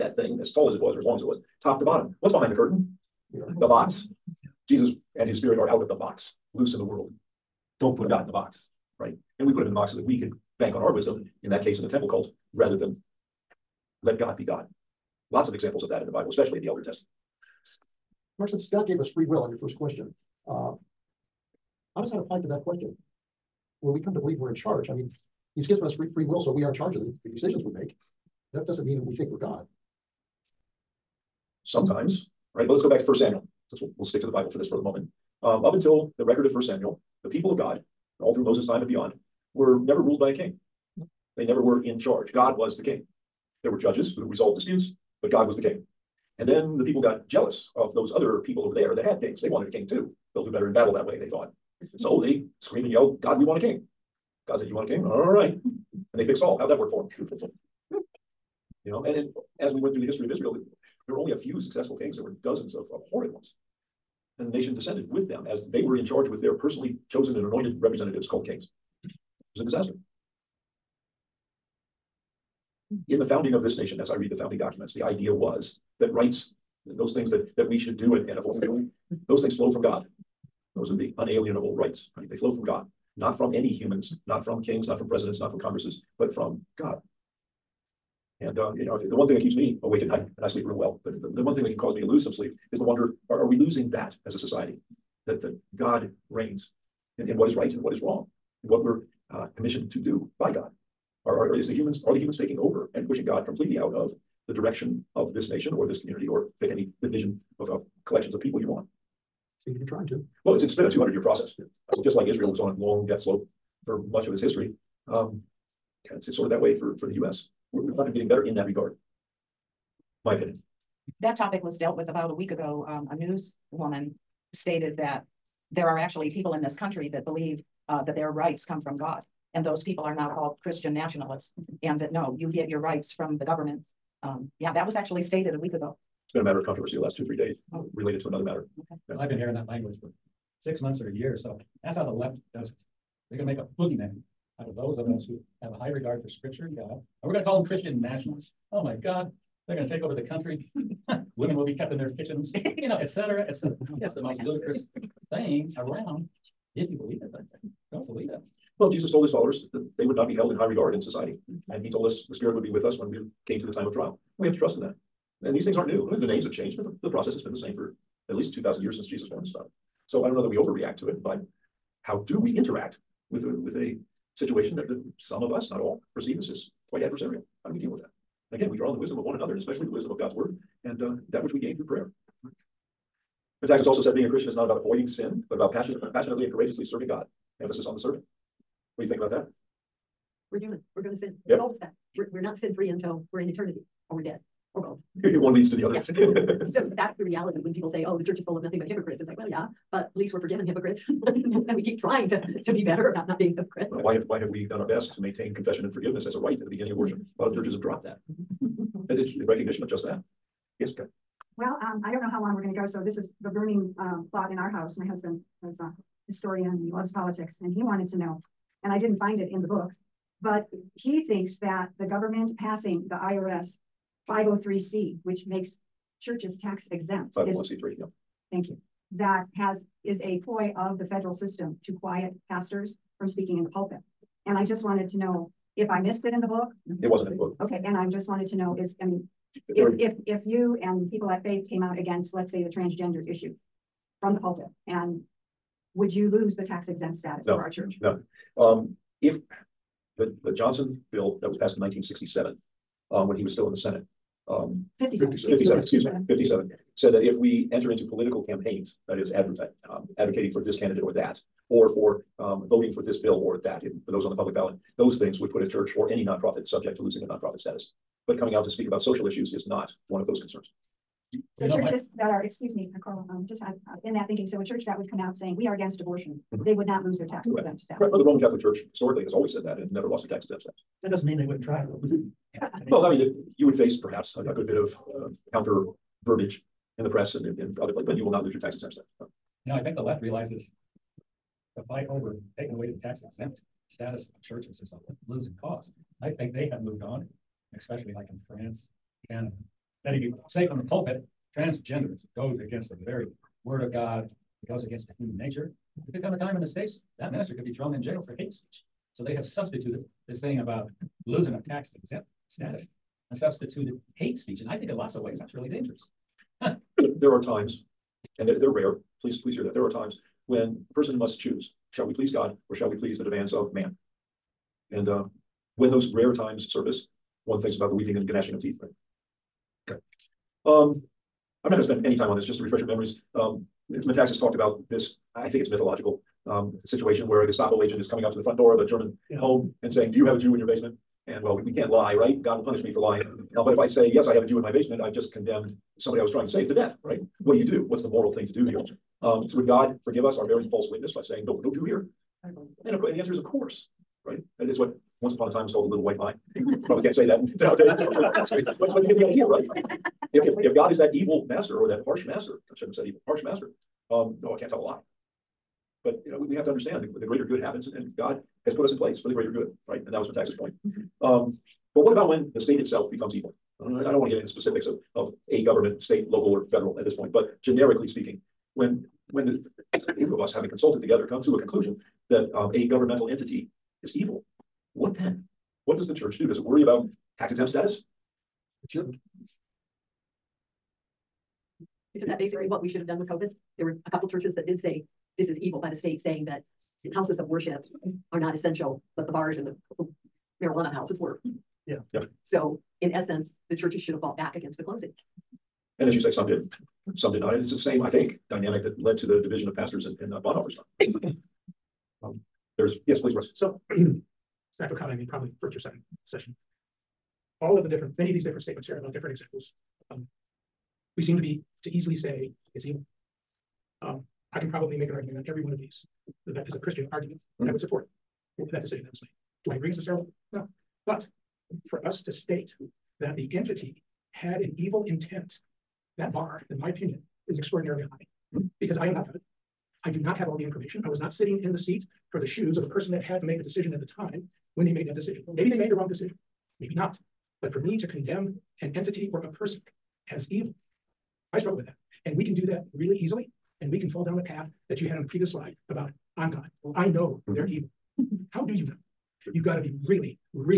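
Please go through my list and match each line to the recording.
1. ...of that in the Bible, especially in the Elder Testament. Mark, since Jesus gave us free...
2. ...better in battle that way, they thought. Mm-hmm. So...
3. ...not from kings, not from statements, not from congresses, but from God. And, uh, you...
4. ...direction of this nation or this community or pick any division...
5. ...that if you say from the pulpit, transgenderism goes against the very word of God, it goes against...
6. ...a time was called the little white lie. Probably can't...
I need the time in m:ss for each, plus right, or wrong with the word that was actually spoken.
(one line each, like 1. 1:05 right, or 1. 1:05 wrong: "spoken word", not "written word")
1. 0:15 wrong: "God", not "Jesus"
2. 0:50 right
3. 1:24 wrong: "presidents", not "statements"
4. 1:44 right
5. 5:00 right
6. 5:55 right.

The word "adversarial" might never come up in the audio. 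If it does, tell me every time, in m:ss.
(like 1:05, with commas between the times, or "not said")
2:57.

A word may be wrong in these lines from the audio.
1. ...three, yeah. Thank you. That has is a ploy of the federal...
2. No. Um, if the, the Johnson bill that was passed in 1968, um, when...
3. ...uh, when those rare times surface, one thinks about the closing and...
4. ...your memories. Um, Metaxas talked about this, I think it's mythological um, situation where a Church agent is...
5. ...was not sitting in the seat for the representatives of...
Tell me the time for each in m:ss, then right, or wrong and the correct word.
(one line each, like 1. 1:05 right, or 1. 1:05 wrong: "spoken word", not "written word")
1. 3:47 right
2. 4:08 wrong: "1967", not "1968"
3. 5:25 wrong: "weeping", not "closing"
4. 5:32 wrong: "Gestapo", not "Church"
5. 7:21 wrong: "shoes", not "representatives".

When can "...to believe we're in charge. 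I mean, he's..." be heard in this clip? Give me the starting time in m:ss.
0:24.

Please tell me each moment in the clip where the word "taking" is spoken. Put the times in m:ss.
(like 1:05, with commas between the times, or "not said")
1:42, 4:52.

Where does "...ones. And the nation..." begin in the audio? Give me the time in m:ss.
1:03.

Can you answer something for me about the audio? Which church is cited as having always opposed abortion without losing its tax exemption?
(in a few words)
Roman Catholic Church.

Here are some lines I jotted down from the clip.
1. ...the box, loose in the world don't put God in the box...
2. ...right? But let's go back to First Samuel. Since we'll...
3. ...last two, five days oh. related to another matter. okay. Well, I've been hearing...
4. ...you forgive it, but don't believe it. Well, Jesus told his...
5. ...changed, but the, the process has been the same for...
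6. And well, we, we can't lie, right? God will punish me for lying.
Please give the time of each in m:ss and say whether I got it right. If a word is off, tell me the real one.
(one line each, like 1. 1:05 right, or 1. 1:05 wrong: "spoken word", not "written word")
1. 0:05 right
2. 0:32 right
3. 2:16 wrong: "three", not "five"
4. 2:36 wrong: "believe", not "forgive"
5. 2:46 right
6. 5:41 right.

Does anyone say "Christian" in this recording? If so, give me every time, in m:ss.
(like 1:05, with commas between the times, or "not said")
2:10, 2:27, 3:04, 7:06.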